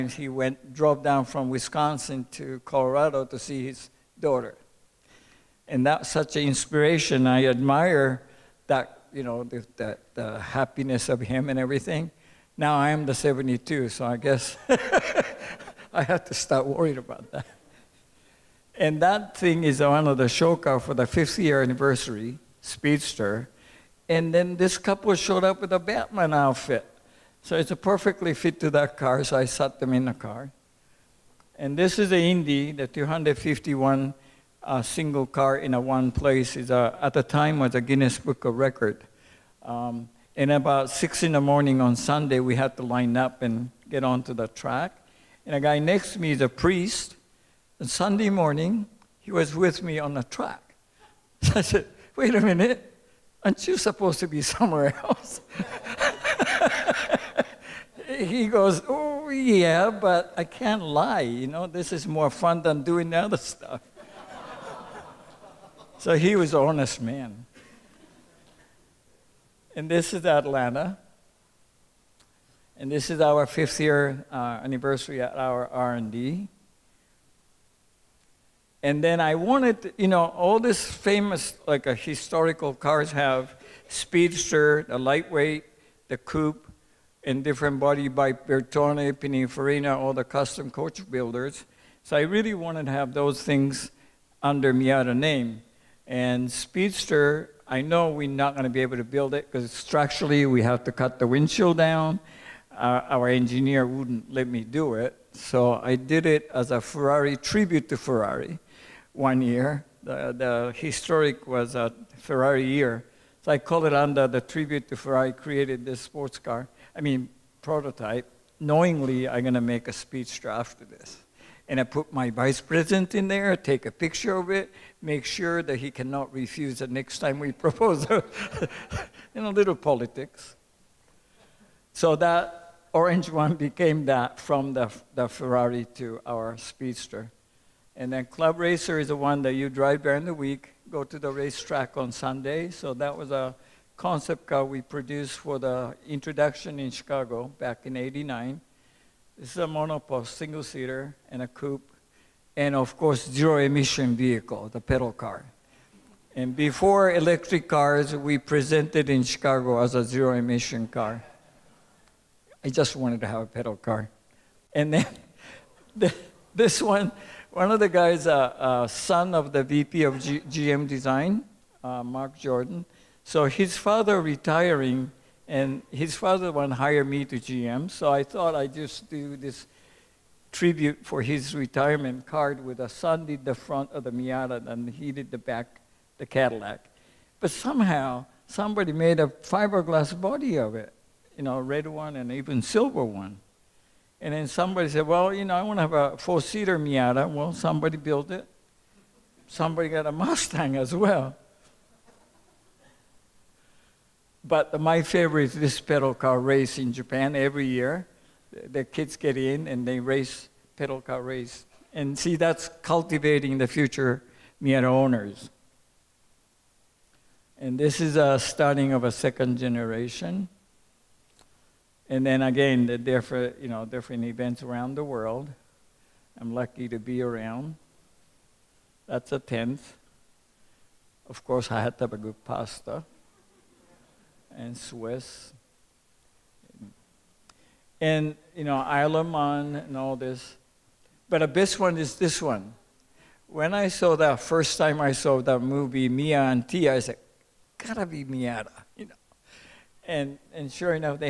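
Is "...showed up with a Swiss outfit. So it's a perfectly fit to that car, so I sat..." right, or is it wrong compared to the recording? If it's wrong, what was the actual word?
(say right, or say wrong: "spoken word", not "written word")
wrong: "Batman", not "Swiss".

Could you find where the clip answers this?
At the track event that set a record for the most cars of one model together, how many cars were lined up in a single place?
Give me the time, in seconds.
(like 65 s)
32 s.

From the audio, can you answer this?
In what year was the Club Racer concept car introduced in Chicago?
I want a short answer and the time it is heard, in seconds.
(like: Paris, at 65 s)
1989, at 147 s.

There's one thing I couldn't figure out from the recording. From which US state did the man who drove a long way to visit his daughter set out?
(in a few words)
Wisconsin.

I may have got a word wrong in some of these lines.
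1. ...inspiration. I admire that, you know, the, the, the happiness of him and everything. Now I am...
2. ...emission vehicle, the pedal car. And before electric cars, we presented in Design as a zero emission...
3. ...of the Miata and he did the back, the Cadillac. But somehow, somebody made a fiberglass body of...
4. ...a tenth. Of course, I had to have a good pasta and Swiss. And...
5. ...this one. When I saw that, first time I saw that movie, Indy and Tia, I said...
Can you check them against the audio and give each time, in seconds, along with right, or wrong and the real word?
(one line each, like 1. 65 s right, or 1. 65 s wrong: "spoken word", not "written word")
1. 6 s right
2. 153 s wrong: "Chicago", not "Design"
3. 183 s right
4. 229 s right
5. 242 s wrong: "Mia", not "Indy".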